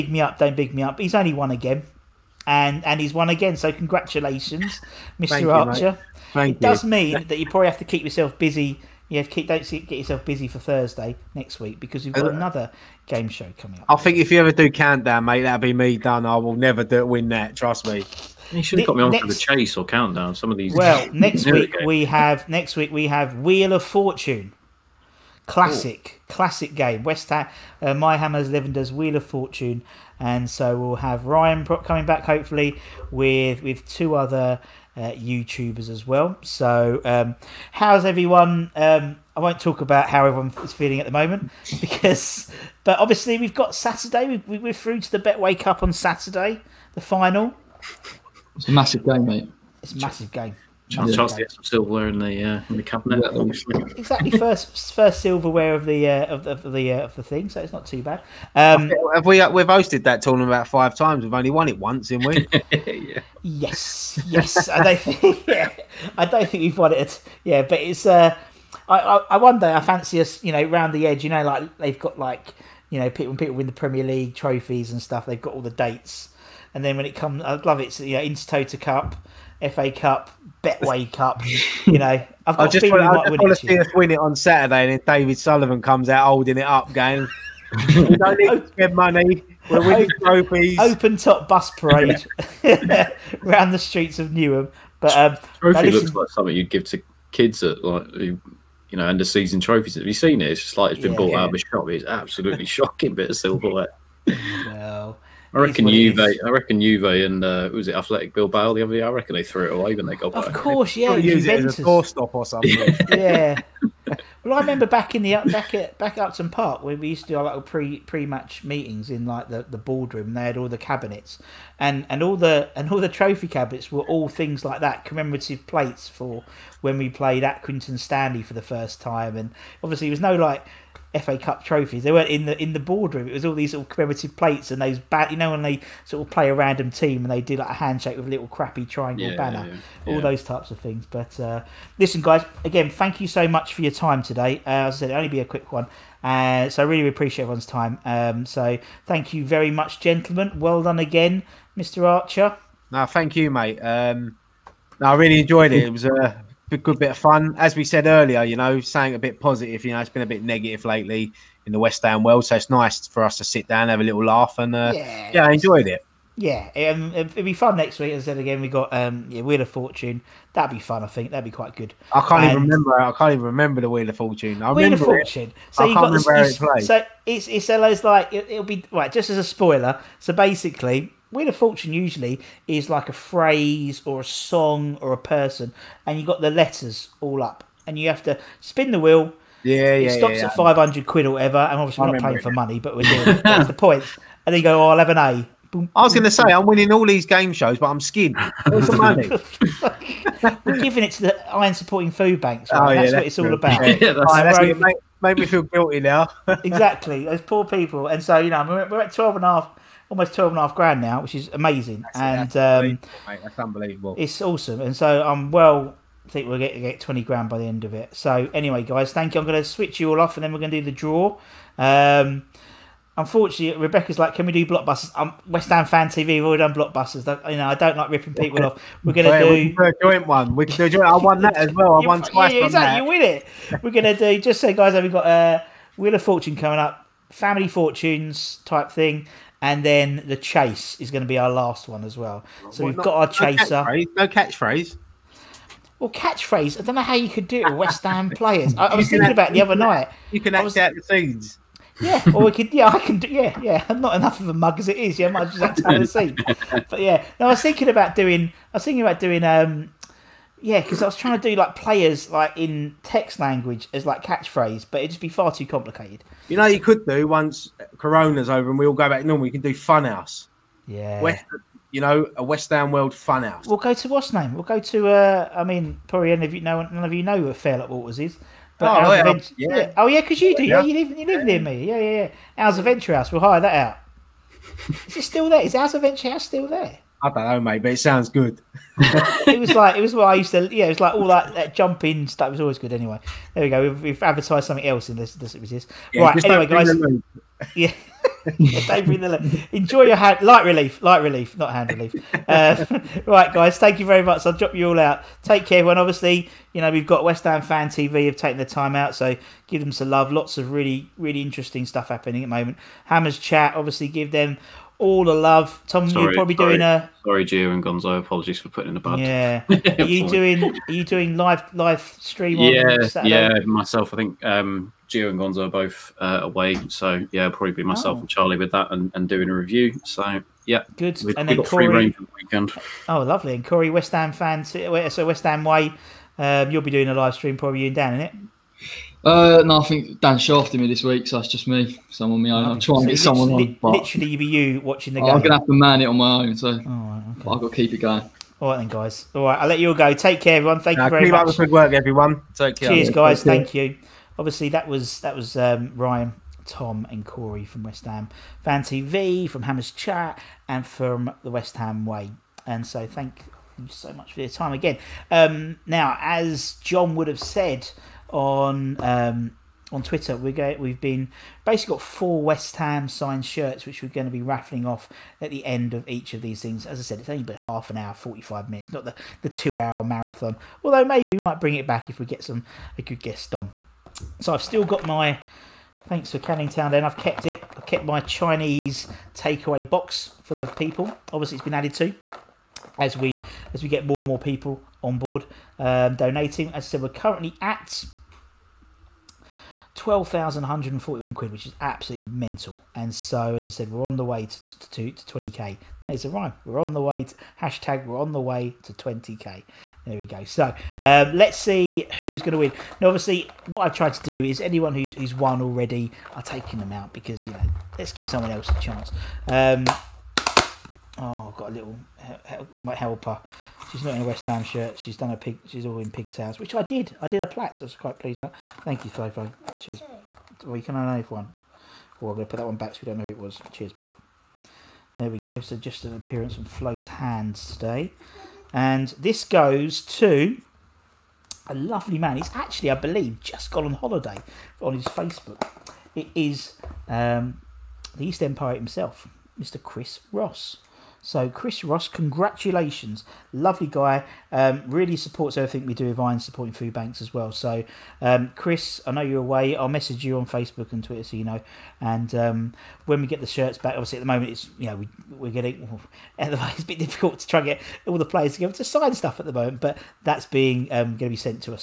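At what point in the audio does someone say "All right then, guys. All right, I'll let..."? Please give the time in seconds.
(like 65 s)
348 s.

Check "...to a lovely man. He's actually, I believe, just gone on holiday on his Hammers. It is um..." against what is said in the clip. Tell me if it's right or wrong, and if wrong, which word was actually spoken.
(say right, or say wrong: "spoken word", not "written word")
wrong: "Facebook", not "Hammers".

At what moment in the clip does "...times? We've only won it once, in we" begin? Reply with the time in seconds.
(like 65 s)
60 s.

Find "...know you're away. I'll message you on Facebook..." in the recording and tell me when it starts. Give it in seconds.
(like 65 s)
459 s.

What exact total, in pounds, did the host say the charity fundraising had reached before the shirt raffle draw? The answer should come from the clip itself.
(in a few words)
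£12,141.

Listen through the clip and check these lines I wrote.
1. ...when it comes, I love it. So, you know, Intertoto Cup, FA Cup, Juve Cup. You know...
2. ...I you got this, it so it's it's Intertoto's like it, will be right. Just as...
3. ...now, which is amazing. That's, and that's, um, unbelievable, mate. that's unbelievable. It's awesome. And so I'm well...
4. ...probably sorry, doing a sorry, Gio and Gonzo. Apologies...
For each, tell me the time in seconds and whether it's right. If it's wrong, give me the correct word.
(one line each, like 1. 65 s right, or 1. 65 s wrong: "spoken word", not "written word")
1. 76 s wrong: "Betway", not "Juve"
2. 175 s wrong: "Ella", not "Intertoto"
3. 211 s right
4. 316 s right.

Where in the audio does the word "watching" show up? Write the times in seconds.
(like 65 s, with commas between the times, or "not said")
344 s.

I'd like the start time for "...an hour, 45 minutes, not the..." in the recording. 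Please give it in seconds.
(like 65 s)
377 s.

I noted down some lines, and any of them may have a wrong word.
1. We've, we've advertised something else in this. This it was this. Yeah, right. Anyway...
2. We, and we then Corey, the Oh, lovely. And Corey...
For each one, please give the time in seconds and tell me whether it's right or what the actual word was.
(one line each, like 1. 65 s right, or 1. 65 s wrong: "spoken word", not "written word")
1. 293 s right
2. 331 s right.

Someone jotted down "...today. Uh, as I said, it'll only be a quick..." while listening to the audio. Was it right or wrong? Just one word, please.
right.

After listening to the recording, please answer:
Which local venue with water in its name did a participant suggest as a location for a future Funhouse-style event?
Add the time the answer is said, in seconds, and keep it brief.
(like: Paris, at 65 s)
Fairlop Waters, at 277 s.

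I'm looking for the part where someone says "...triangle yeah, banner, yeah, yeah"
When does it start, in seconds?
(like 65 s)
138 s.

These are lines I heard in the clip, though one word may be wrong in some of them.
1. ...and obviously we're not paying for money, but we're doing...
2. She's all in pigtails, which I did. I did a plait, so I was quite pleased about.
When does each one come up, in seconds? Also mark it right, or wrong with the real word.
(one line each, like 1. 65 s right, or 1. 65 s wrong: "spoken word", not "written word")
1. 191 s right
2. 425 s right.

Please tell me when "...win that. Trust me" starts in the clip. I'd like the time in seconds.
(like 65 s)
17 s.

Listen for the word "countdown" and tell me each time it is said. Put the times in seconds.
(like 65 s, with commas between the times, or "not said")
14 s, 19 s.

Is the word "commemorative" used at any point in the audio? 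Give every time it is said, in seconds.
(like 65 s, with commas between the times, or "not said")
125 s, 133 s.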